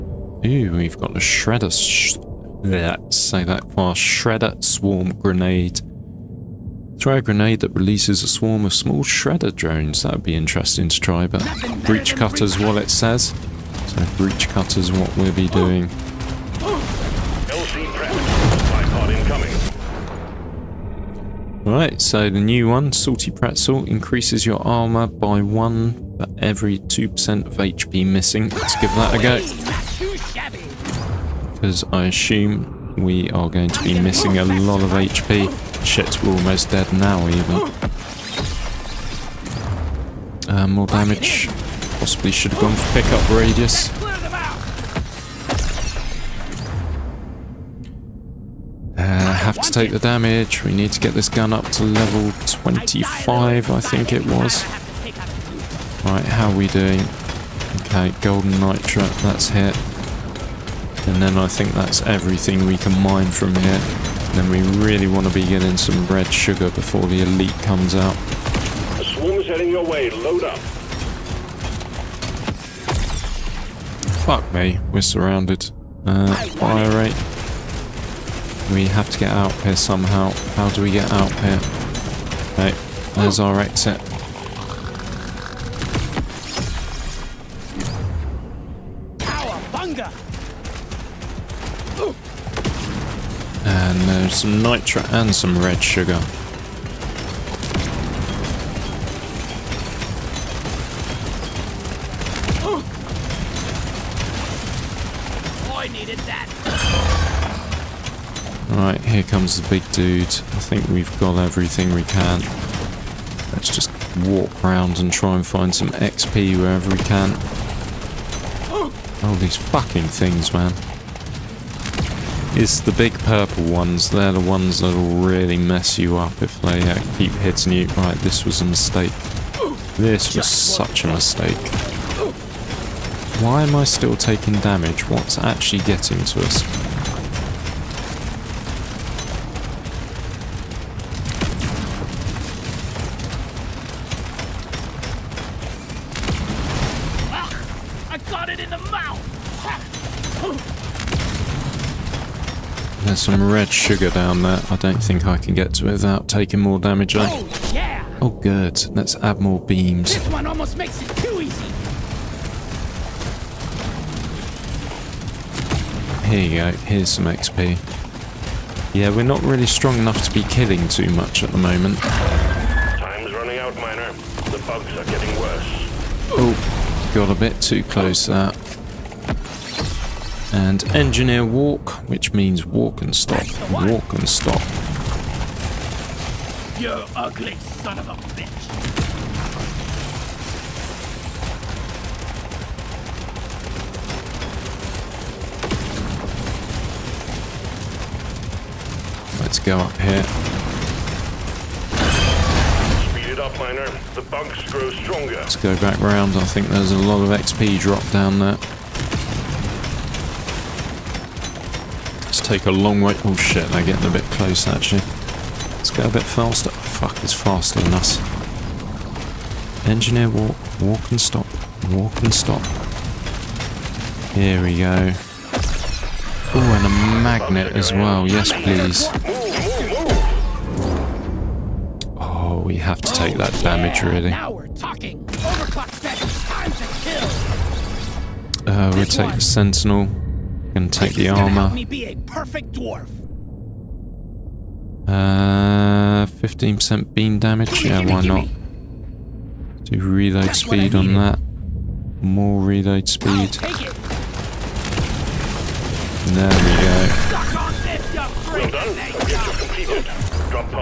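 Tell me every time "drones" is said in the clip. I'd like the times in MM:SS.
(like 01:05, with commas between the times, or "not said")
00:09.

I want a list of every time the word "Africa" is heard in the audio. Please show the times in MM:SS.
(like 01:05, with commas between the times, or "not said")
not said.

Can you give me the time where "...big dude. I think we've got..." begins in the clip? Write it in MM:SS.
01:49.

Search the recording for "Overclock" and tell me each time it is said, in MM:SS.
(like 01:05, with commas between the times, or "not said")
03:55.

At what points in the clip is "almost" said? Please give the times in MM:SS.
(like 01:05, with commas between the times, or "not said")
00:36, 02:40.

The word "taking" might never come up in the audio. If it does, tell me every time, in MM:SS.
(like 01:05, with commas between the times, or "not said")
02:14, 02:36.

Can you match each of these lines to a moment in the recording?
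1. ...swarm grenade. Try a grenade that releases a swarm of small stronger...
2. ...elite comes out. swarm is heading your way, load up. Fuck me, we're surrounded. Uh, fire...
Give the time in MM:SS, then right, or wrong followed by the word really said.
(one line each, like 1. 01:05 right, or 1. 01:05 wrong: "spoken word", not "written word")
1. 00:04 wrong: "shredder", not "stronger"
2. 01:07 right.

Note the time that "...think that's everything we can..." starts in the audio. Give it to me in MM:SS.
01:01.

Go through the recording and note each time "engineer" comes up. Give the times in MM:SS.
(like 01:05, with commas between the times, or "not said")
03:00, 03:39.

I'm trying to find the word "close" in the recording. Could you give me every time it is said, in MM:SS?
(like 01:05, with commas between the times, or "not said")
02:57, 03:34.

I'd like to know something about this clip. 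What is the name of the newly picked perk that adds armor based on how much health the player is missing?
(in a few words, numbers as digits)
Salty Pretzel.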